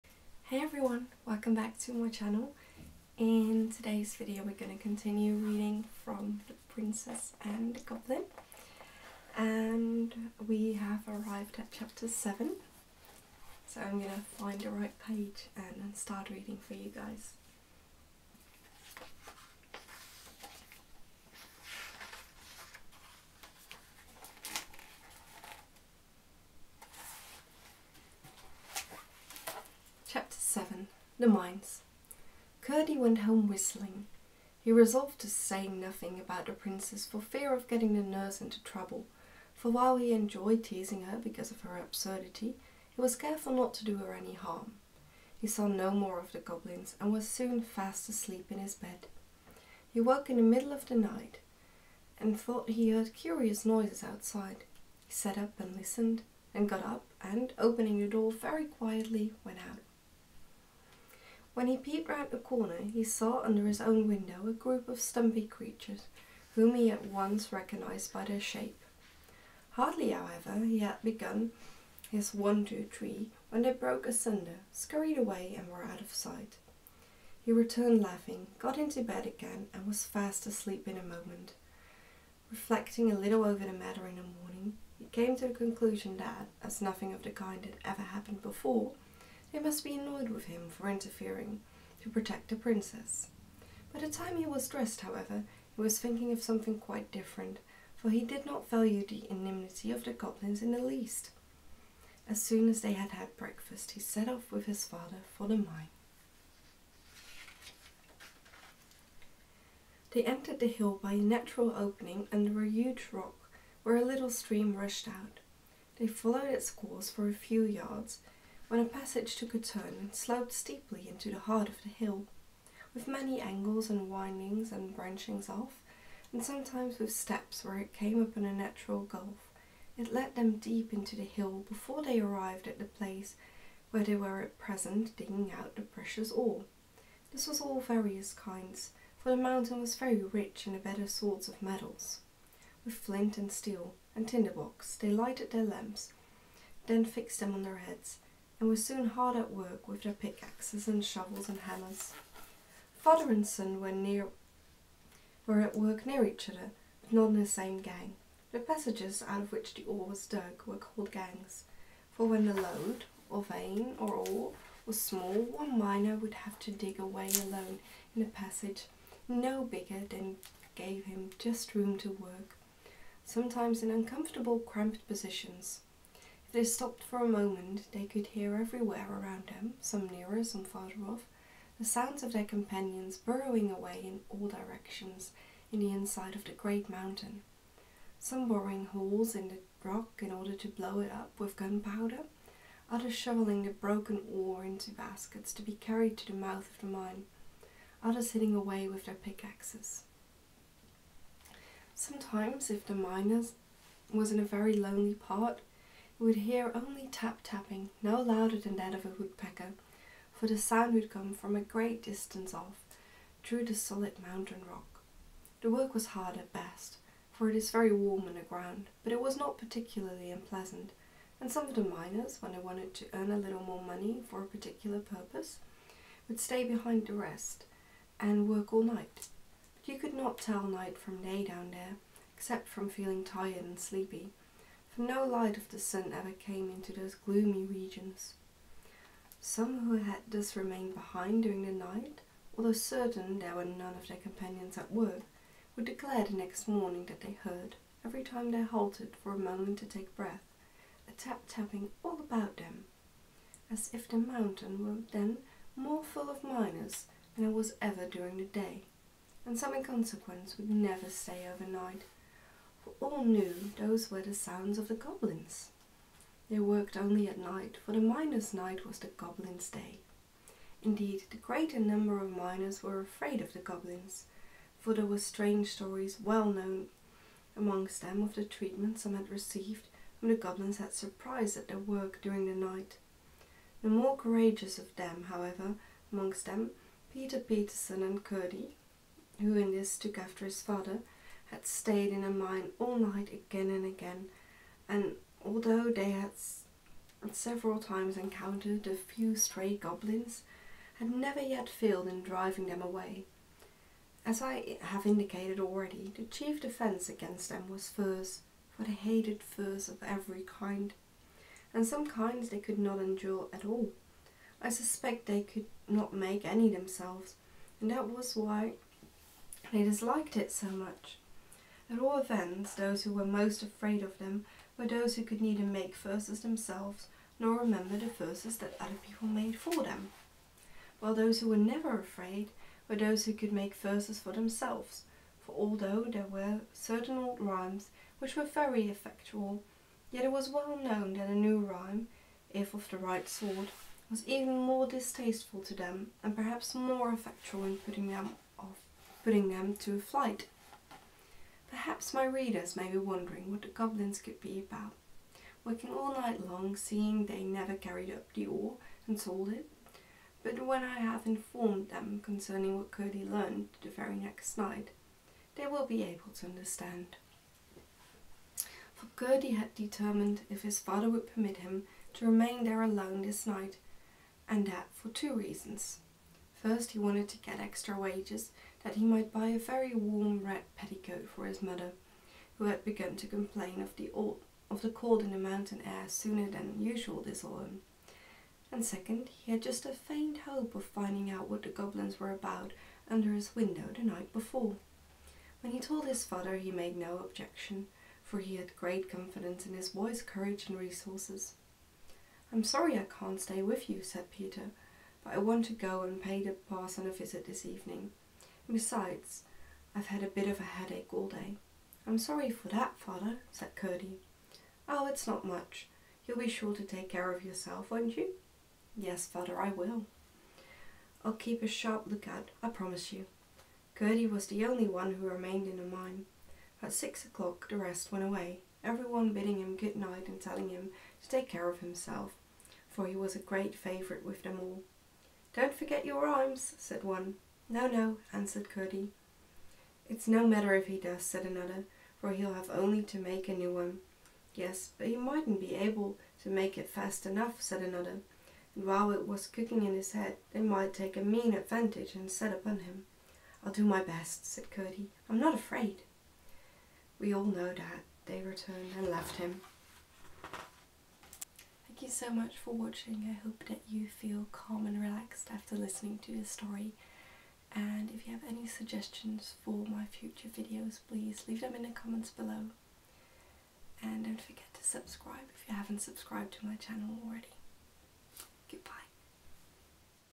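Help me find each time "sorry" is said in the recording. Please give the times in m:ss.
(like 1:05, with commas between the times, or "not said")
6:42, 6:52.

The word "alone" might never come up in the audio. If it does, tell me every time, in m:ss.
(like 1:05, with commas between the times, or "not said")
2:47, 6:12.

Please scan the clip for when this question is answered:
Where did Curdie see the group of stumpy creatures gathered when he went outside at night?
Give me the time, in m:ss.
1:03.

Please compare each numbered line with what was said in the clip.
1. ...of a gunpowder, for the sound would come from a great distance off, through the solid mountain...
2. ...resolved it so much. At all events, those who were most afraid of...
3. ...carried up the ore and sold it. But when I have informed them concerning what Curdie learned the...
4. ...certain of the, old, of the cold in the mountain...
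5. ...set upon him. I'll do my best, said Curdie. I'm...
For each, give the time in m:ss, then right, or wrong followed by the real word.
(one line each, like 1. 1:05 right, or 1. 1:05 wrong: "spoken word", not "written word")
1. 3:28 wrong: "woodpecker", not "gunpowder"
2. 5:19 wrong: "disliked", not "resolved"
3. 5:57 right
4. 6:23 wrong: "complain", not "certain"
5. 7:32 right.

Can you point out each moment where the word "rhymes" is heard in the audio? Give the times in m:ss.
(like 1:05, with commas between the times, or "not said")
5:37, 5:41, 7:16.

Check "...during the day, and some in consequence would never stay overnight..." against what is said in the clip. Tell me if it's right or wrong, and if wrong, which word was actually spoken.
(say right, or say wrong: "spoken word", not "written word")
right.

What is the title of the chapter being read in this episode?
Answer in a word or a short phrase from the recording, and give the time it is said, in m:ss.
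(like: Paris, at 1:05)
The Mines, at 0:31.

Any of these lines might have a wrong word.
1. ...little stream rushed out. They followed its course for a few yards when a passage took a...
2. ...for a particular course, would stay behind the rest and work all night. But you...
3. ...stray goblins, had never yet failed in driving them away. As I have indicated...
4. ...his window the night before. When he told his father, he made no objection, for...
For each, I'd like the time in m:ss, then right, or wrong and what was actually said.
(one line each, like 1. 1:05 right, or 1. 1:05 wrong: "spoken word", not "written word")
1. 1:54 right
2. 3:44 wrong: "purpose", not "course"
3. 4:59 right
4. 6:33 right.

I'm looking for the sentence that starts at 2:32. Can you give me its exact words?
Father and son were near were at work near each other, but not in the same gang.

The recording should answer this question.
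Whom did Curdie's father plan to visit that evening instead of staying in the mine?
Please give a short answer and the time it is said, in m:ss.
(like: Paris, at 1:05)
The parson, at 6:46.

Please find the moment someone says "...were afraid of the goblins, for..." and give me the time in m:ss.
4:32.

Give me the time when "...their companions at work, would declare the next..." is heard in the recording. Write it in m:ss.
4:04.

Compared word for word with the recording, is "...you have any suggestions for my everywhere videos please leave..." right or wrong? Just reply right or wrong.
wrong.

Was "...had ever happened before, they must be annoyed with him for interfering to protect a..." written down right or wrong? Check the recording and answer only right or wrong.
right.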